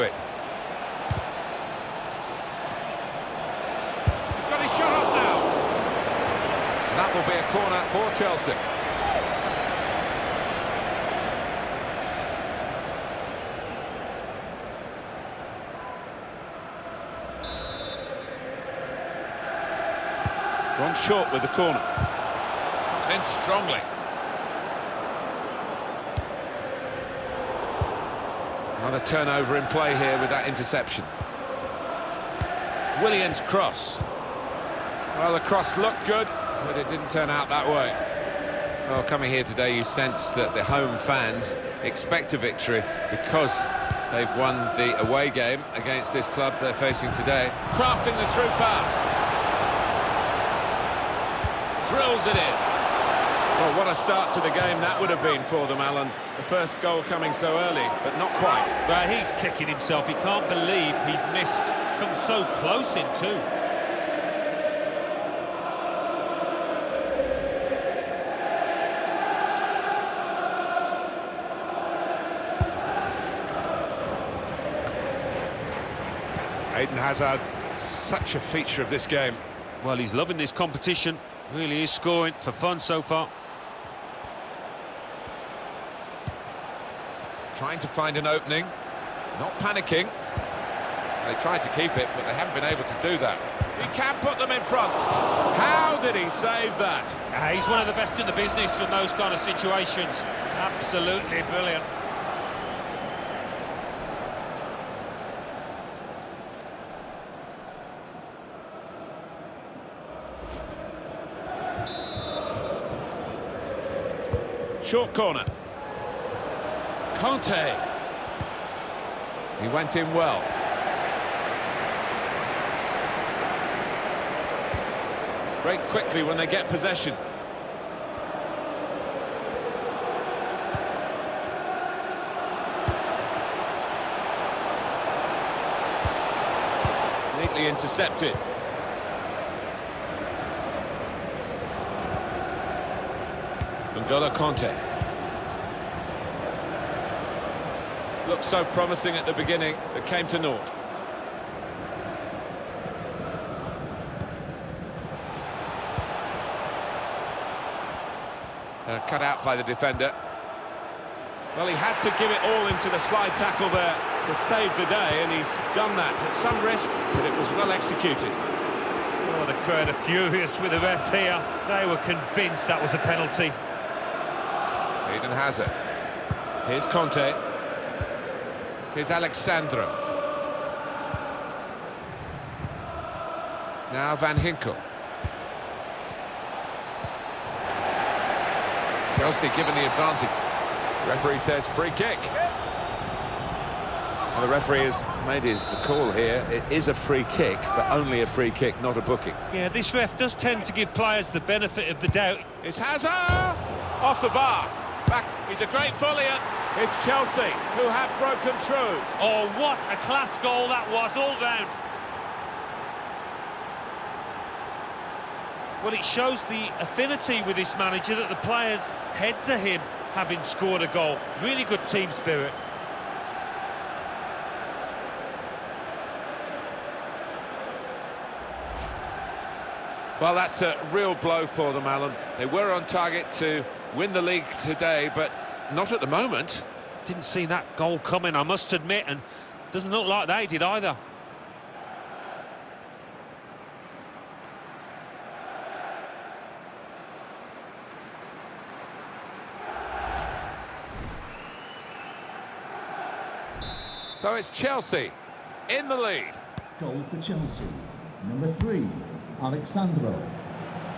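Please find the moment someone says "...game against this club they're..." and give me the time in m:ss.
0:45.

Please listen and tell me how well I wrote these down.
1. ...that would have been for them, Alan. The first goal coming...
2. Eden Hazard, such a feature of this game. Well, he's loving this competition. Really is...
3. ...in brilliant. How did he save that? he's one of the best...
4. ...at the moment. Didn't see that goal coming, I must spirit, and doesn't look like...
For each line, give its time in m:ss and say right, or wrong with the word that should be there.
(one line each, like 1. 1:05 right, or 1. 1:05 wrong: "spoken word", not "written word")
1. 0:54 right
2. 1:16 right
3. 1:34 wrong: "front", not "brilliant"
4. 3:55 wrong: "admit", not "spirit".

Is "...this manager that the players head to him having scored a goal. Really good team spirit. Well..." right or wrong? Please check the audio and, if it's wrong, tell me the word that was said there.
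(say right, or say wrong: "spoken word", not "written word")
right.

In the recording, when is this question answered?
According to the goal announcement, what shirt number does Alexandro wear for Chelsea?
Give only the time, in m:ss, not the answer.
4:18.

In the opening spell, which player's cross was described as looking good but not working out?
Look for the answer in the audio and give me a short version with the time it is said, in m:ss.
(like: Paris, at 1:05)
Williams, at 0:33.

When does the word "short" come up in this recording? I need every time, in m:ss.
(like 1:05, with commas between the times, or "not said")
0:20, 1:54.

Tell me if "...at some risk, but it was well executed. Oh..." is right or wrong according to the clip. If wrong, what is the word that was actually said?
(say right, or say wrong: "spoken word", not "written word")
right.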